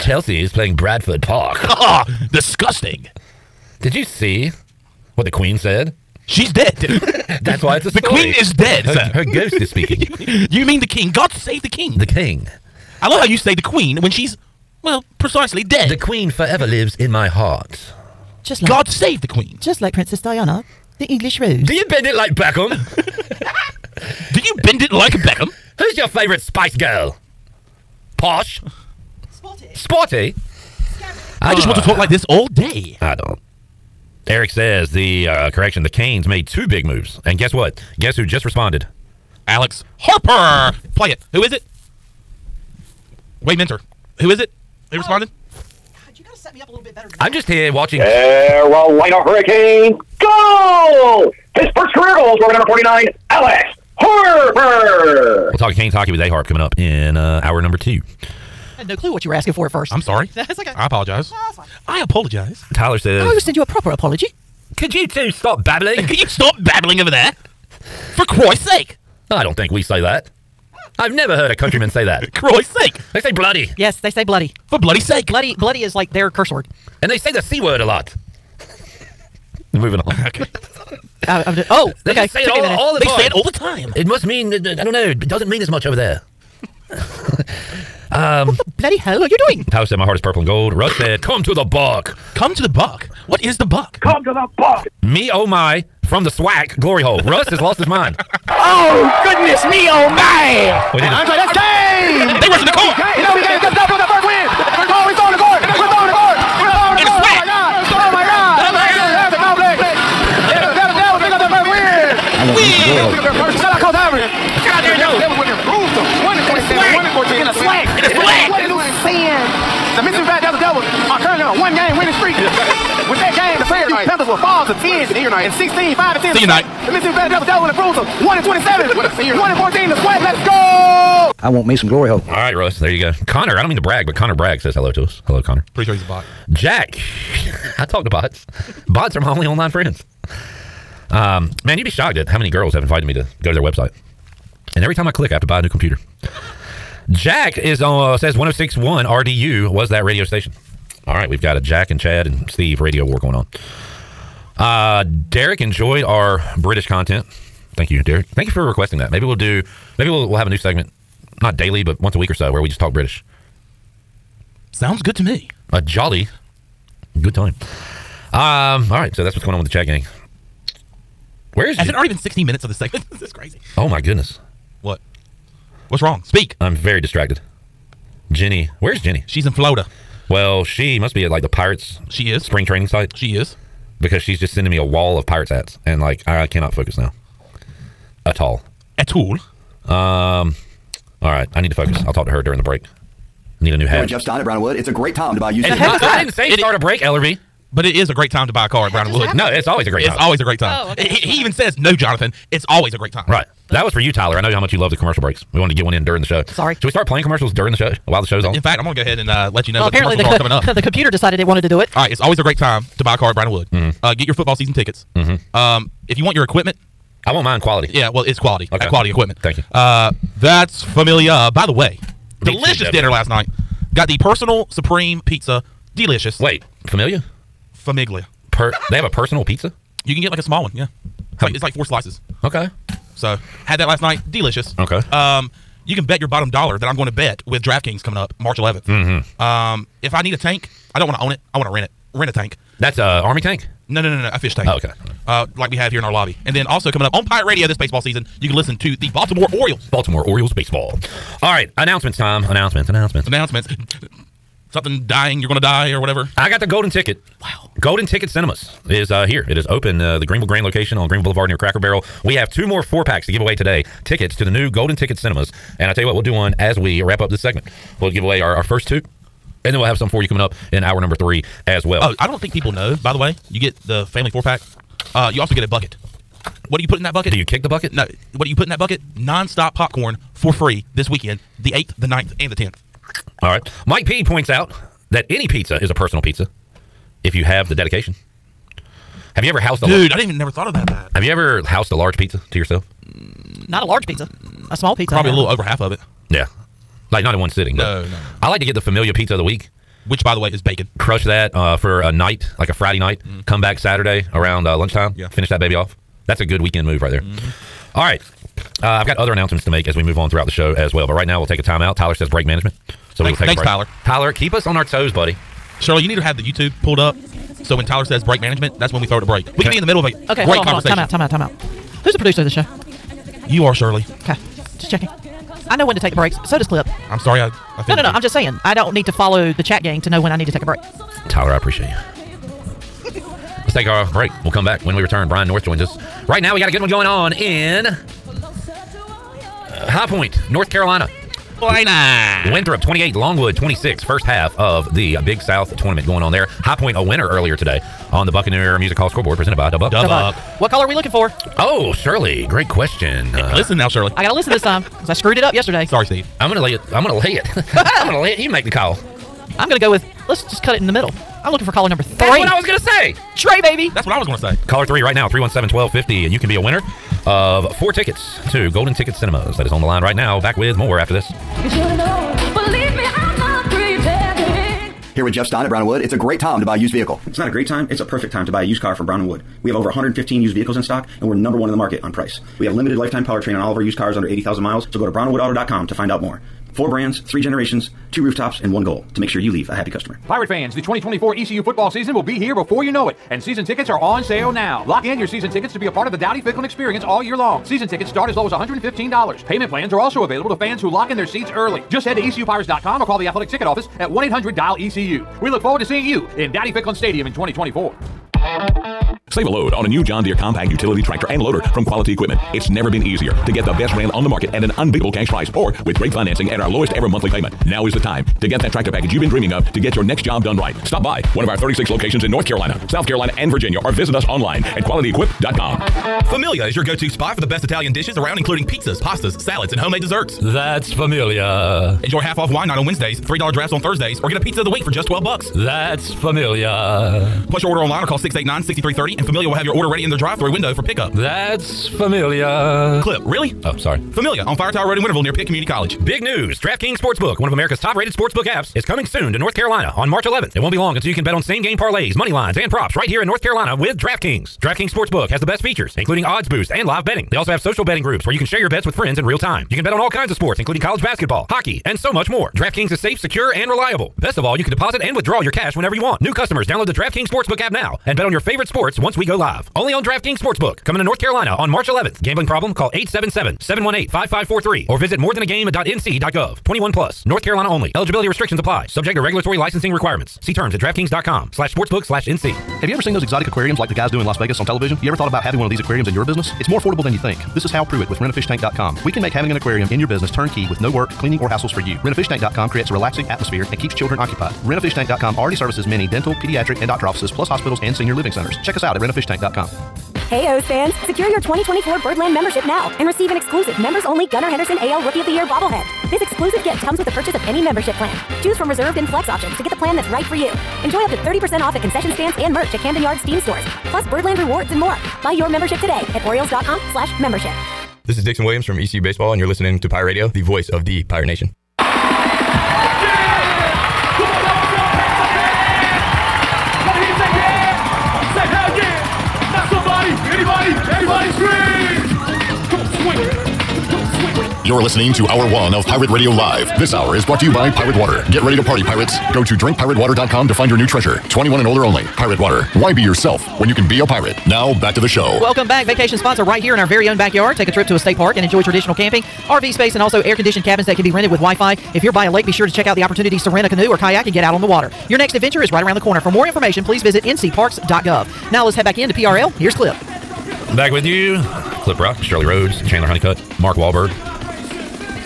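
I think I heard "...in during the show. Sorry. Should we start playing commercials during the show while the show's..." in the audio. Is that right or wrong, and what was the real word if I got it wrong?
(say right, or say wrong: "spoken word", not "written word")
right.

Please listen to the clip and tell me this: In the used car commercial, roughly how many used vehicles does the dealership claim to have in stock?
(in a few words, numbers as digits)
over 115.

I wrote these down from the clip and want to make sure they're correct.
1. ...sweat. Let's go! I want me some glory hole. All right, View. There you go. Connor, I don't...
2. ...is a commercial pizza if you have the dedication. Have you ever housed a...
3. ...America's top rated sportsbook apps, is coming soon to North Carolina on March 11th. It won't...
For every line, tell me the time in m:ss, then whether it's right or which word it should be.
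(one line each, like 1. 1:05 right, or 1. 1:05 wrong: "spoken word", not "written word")
1. 2:10 wrong: "Russ", not "View"
2. 4:45 wrong: "personal", not "commercial"
3. 7:27 right.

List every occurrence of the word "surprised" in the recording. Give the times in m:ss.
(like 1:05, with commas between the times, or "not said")
not said.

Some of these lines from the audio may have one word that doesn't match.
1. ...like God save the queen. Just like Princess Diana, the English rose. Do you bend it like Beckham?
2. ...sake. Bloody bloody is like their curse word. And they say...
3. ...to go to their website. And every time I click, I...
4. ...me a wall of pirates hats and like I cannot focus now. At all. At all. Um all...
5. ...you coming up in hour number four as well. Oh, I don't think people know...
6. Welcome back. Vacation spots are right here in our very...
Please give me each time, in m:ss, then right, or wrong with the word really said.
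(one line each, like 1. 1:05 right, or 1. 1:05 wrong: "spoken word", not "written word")
1. 0:18 right
2. 1:14 right
3. 2:23 right
4. 3:04 right
5. 4:30 wrong: "three", not "four"
6. 9:05 right.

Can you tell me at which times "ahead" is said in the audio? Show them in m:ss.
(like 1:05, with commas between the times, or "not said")
3:29.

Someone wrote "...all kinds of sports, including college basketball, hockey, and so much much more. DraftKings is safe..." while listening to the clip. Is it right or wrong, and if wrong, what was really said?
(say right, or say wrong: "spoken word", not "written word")
right.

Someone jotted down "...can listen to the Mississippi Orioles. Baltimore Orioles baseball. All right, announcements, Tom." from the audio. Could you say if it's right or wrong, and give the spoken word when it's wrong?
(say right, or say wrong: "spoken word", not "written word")
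wrong: "Baltimore", not "Mississippi".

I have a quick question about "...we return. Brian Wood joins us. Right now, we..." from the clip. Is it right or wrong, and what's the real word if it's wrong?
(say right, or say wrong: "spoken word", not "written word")
wrong: "North", not "Wood".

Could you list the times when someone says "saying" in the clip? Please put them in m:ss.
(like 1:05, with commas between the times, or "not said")
1:59, 5:28.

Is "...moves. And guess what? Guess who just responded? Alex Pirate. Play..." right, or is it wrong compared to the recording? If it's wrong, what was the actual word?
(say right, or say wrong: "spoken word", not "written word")
wrong: "Harper", not "Pirate".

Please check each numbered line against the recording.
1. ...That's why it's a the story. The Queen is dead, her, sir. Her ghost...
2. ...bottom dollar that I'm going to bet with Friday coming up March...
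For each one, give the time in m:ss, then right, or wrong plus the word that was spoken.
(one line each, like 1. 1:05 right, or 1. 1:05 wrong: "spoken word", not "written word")
1. 0:07 right
2. 3:56 wrong: "DraftKings", not "Friday".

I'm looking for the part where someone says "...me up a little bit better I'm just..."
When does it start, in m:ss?
0:46.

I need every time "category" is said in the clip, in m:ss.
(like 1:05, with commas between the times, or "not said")
not said.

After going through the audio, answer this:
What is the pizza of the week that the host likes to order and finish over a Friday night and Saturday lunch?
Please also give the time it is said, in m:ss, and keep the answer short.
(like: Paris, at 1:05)
bacon, at 5:00.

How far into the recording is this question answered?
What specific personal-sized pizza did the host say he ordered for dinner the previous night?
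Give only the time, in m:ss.
3:44.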